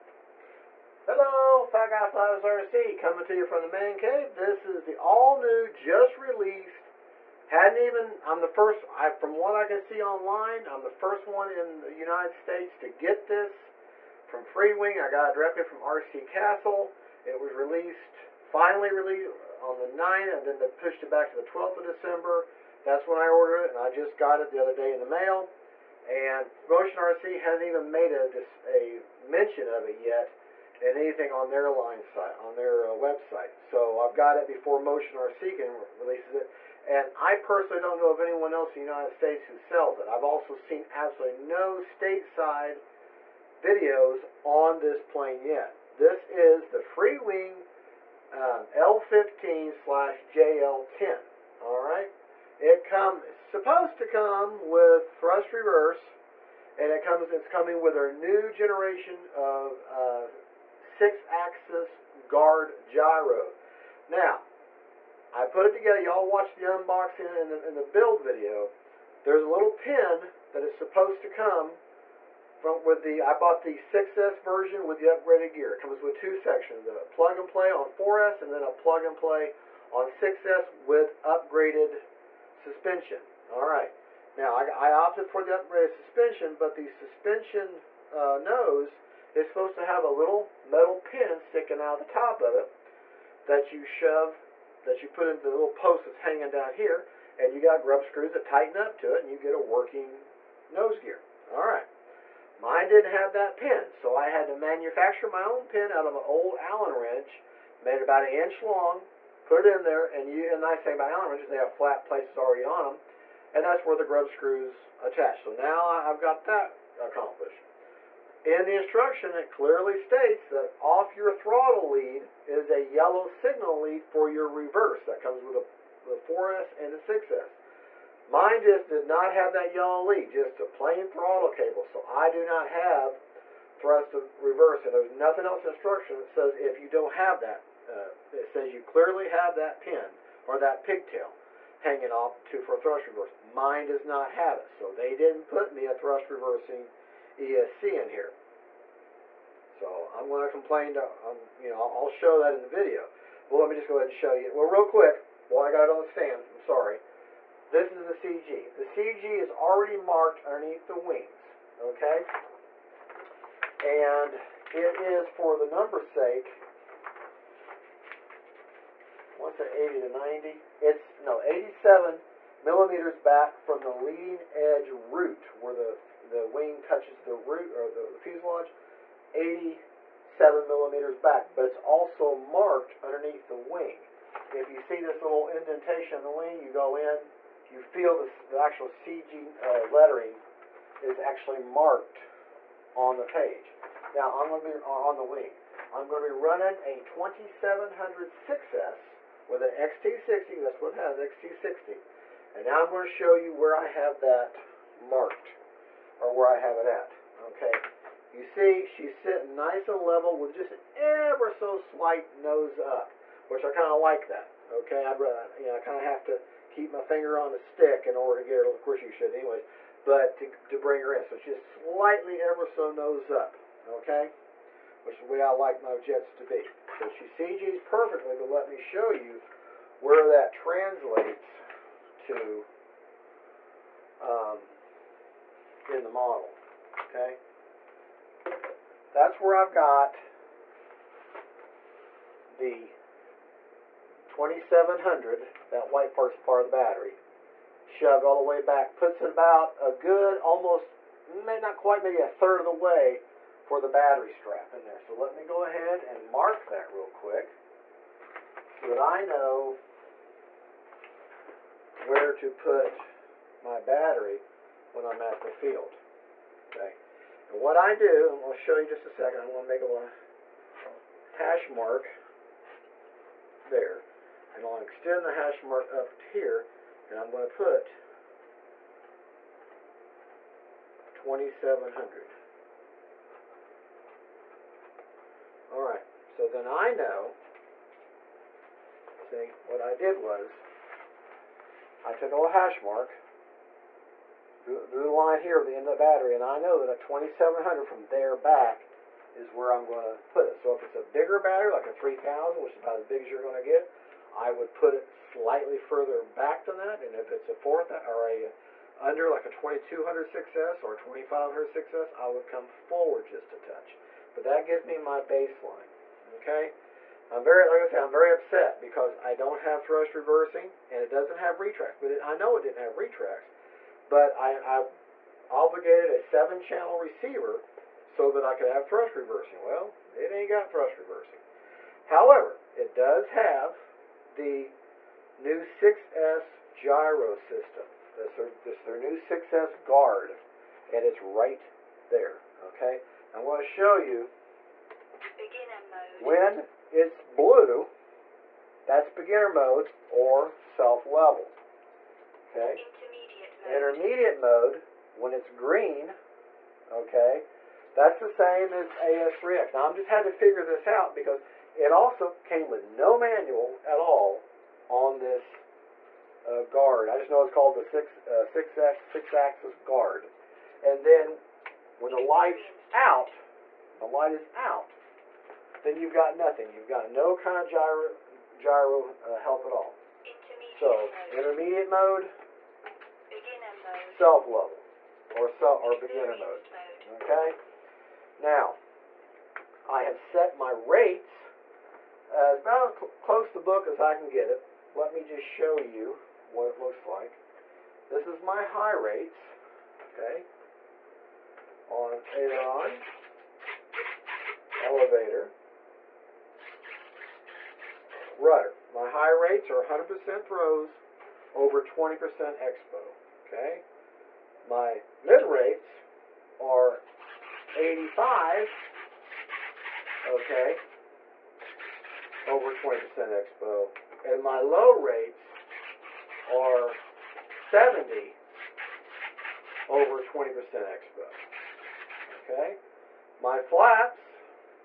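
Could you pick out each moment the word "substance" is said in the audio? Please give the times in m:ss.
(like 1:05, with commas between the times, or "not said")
not said.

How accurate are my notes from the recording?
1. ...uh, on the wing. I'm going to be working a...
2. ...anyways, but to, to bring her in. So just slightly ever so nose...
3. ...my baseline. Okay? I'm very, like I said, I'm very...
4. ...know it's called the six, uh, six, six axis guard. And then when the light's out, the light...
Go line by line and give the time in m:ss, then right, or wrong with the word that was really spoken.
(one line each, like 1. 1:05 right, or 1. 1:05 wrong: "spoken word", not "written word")
1. 3:14 wrong: "running", not "working"
2. 3:39 right
3. 5:14 right
4. 6:07 right.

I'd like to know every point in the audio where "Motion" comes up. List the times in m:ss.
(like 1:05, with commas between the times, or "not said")
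0:26, 0:34.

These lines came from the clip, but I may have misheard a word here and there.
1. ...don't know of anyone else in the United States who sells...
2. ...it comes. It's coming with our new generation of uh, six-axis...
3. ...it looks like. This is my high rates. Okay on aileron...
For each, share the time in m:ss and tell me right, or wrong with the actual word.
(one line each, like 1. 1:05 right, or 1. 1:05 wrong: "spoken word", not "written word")
1. 0:37 right
2. 0:56 right
3. 6:36 right.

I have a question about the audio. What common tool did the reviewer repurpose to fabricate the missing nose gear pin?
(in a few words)
Allen wrench.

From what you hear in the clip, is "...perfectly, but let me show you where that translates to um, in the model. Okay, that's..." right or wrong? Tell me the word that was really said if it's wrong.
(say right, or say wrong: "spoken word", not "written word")
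right.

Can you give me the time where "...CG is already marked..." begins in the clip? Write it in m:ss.
2:38.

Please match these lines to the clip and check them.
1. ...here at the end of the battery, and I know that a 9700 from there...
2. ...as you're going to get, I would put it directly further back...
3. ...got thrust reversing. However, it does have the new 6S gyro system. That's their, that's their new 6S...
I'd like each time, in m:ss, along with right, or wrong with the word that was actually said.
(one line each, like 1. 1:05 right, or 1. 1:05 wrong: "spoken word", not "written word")
1. 4:55 wrong: "2700", not "9700"
2. 5:03 wrong: "slightly", not "directly"
3. 5:30 right.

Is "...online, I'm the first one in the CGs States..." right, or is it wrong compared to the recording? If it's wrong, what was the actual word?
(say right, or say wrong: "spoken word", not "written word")
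wrong: "United", not "CGs".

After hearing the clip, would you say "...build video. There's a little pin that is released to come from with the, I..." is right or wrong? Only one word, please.
wrong.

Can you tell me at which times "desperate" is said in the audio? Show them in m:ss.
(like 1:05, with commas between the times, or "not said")
not said.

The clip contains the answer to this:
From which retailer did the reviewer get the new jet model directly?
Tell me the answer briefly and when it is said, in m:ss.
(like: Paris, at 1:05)
RC Castle, at 0:15.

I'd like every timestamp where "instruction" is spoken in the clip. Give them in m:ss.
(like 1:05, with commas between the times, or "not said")
1:58, 2:15.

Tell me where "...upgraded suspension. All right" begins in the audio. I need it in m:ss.
1:21.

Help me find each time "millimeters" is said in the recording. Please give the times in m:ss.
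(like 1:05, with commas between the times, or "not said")
2:52, 3:00.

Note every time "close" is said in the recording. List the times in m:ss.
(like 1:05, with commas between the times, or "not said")
6:33.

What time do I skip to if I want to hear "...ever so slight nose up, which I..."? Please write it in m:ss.
3:30.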